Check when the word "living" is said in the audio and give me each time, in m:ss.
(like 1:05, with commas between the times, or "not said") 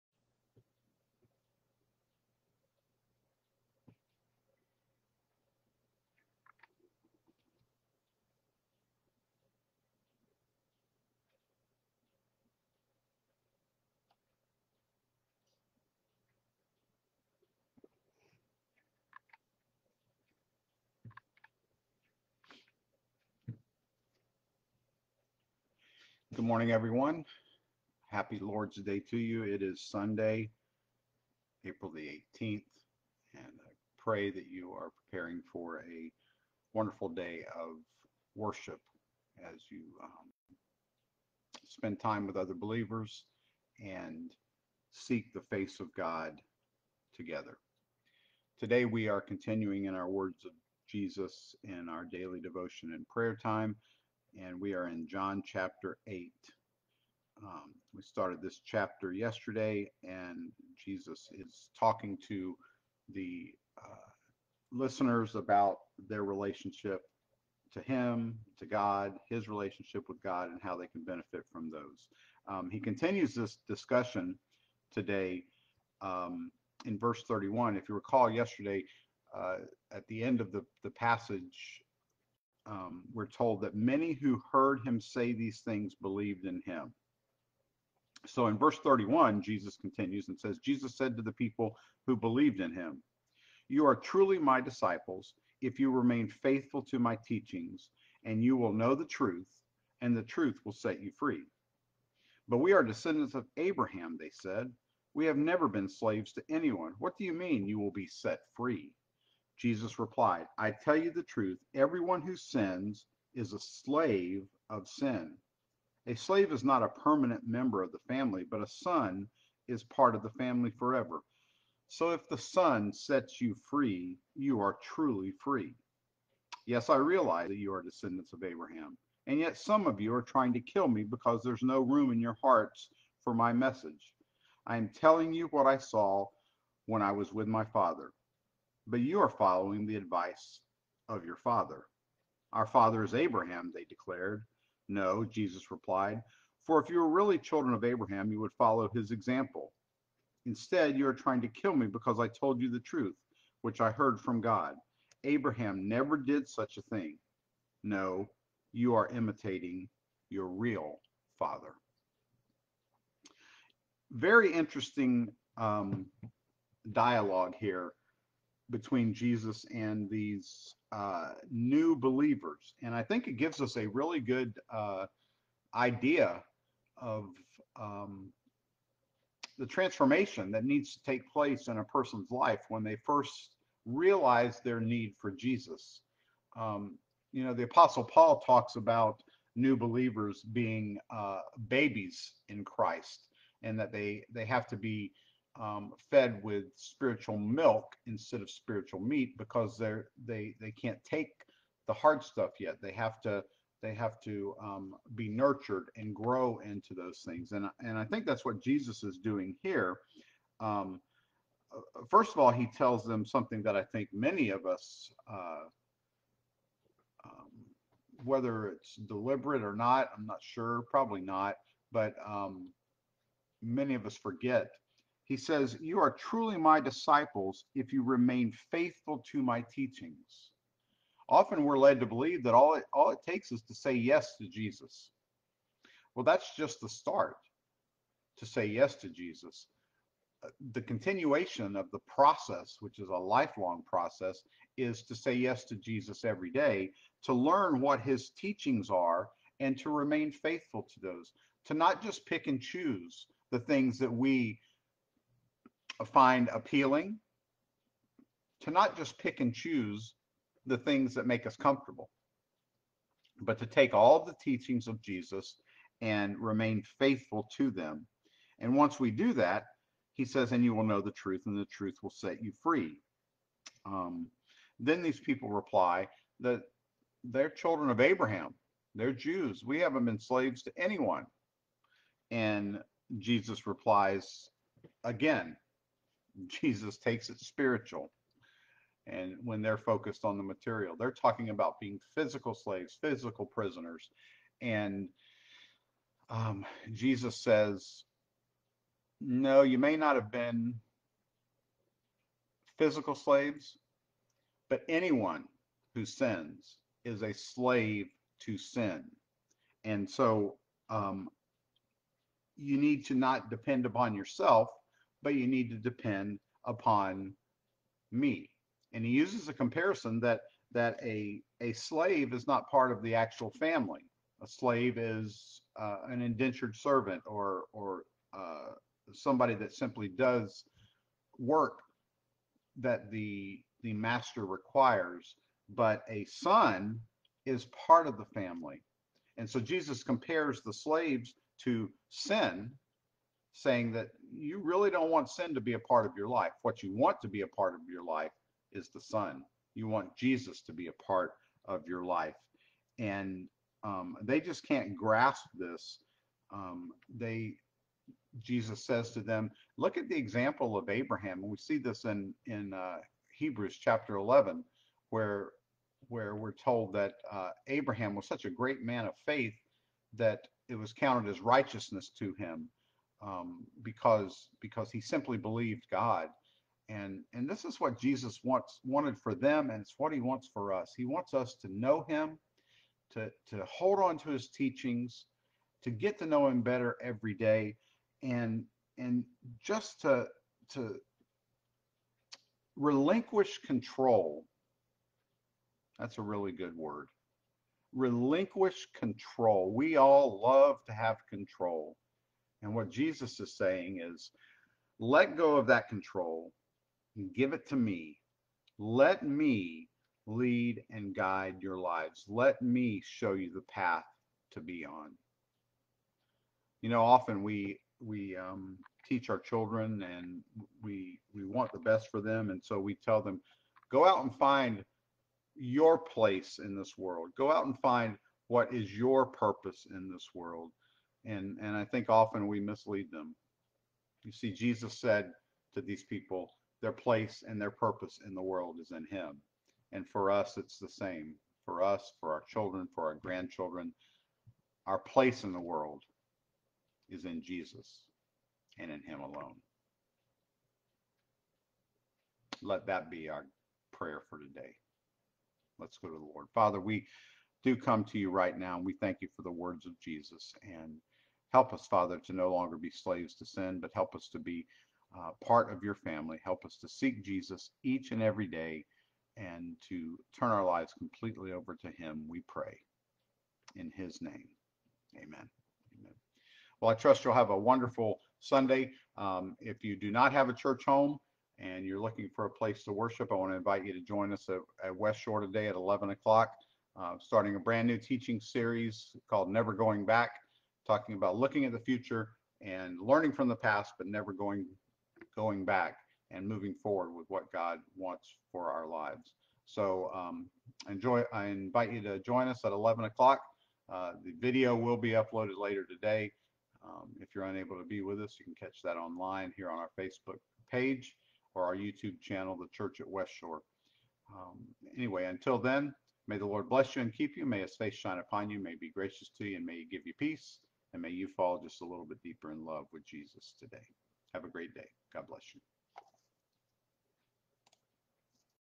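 not said.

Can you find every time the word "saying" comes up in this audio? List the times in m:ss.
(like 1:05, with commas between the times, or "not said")
5:43, 6:43.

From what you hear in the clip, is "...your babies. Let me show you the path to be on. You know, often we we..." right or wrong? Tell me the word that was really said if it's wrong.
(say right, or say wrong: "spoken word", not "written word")
wrong: "lives", not "babies".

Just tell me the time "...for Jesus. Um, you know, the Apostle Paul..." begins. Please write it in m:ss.
3:05.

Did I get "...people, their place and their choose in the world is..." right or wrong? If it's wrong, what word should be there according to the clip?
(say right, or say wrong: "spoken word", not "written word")
wrong: "purpose", not "choose".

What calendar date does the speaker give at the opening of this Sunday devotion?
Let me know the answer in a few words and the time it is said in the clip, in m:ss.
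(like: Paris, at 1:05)
April 18, at 0:31.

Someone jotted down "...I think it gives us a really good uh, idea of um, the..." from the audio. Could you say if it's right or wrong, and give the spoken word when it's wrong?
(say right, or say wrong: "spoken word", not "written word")
right.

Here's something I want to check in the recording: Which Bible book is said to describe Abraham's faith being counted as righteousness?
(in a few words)
Hebrews.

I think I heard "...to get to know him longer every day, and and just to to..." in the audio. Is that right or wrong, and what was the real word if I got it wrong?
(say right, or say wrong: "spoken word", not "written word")
wrong: "better", not "longer".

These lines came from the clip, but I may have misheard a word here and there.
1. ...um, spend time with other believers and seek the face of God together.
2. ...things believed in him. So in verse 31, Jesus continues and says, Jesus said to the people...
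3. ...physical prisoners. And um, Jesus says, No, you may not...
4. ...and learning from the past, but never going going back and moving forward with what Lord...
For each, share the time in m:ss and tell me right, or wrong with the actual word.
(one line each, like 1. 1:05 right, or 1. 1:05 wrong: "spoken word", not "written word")
1. 0:40 right
2. 1:25 right
3. 4:53 right
4. 8:12 wrong: "God", not "Lord".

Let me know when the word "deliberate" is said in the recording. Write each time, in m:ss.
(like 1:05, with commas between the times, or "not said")
3:38.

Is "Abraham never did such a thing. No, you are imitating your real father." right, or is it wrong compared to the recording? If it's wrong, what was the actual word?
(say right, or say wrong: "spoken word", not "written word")
right.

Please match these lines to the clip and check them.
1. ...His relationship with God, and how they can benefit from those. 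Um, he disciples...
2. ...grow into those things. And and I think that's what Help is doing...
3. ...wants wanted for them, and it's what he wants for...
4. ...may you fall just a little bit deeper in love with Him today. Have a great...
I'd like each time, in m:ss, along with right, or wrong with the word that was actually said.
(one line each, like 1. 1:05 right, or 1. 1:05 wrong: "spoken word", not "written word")
1. 1:09 wrong: "continues", not "disciples"
2. 3:26 wrong: "Jesus", not "Help"
3. 6:18 right
4. 8:41 wrong: "Jesus", not "Him".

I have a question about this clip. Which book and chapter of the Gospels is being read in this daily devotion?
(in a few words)
John 8.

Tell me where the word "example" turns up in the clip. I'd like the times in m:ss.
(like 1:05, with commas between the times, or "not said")
2:29, 6:00.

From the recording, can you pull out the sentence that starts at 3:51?
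Often we're led to believe that all it, all it takes is to say yes to Jesus.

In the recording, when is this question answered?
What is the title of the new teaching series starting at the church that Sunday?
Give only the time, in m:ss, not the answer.
8:09.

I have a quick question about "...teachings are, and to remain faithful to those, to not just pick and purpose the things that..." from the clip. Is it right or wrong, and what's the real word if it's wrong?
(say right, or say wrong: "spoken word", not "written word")
wrong: "choose", not "purpose".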